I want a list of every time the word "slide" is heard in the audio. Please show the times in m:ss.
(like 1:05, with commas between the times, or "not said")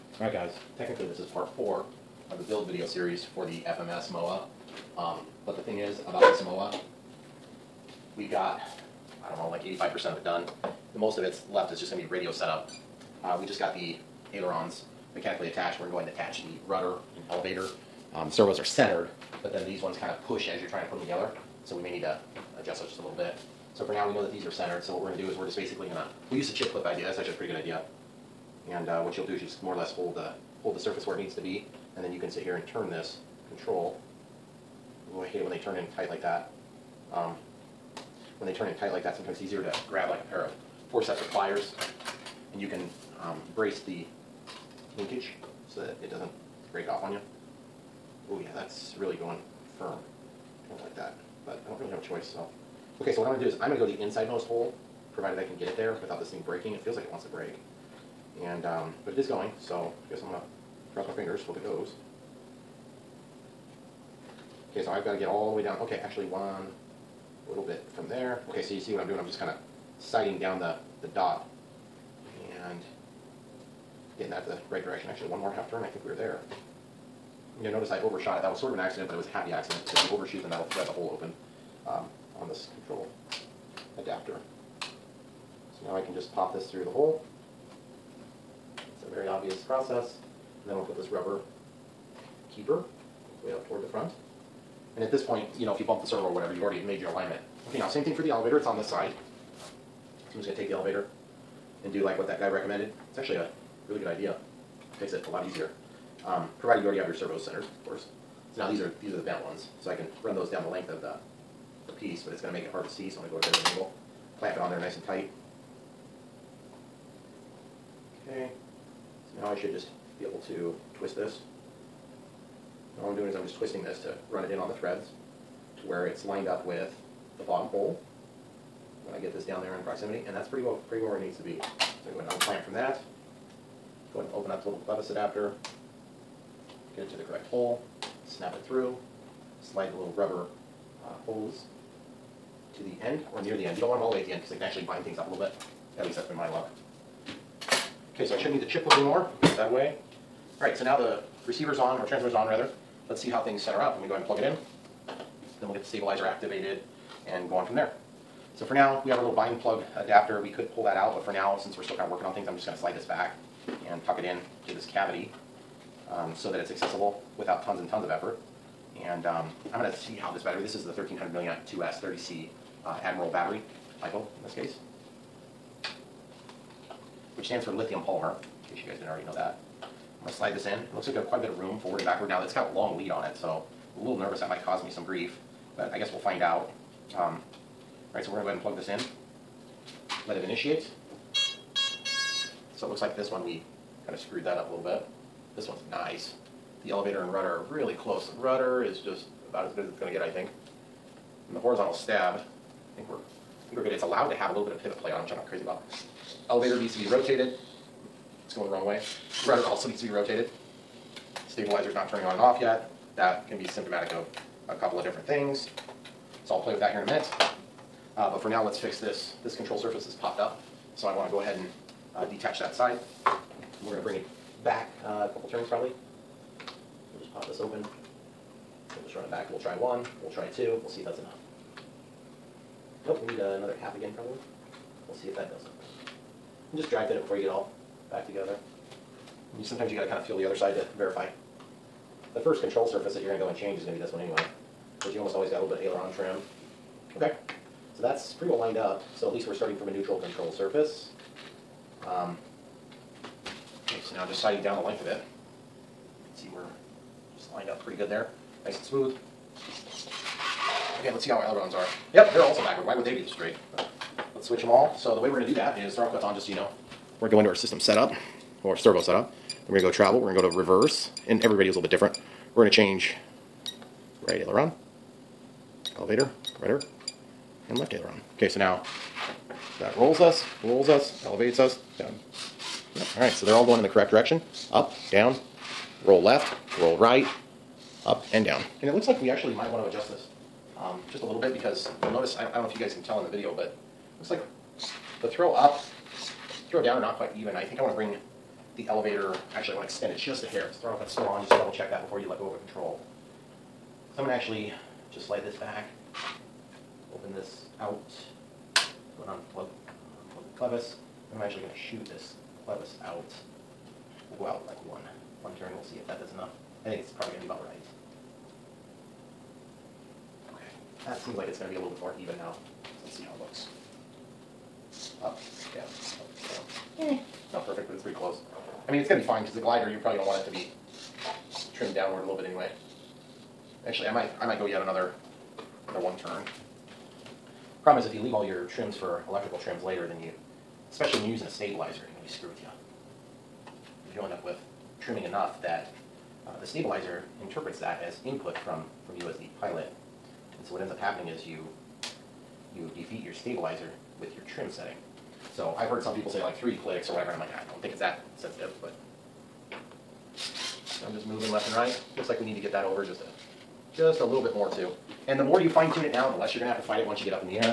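2:19, 2:42, 3:00, 5:05.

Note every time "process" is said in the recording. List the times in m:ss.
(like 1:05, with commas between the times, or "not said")
1:29.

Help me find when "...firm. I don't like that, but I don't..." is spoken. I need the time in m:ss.
0:49.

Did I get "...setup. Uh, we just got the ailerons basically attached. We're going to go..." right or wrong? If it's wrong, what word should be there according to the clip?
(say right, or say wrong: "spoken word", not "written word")
wrong: "mechanically", not "basically".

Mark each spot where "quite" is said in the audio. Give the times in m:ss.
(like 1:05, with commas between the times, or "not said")
3:01, 4:57.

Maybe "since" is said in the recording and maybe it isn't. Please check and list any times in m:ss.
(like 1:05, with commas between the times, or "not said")
2:41.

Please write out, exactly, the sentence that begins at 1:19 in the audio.
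If you overshoot, then that'll thread the hole open um, on this control adapter.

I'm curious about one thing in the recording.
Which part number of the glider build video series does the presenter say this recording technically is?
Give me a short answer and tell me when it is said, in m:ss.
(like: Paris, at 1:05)
4, at 0:01.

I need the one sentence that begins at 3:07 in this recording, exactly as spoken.
Um, all right, so we're going to go ahead and plug this in.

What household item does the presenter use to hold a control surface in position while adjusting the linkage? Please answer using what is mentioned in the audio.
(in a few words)
chip clip.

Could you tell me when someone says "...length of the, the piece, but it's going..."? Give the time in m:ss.
1:50.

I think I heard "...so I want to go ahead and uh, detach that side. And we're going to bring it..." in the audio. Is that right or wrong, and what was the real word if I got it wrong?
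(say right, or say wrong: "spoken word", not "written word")
right.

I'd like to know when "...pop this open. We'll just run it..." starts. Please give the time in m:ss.
3:47.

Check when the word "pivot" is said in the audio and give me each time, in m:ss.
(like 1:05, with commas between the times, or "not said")
3:24.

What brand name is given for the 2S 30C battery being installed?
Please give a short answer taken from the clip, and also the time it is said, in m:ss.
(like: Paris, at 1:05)
Admiral, at 2:53.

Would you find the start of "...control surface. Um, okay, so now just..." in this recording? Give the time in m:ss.
4:10.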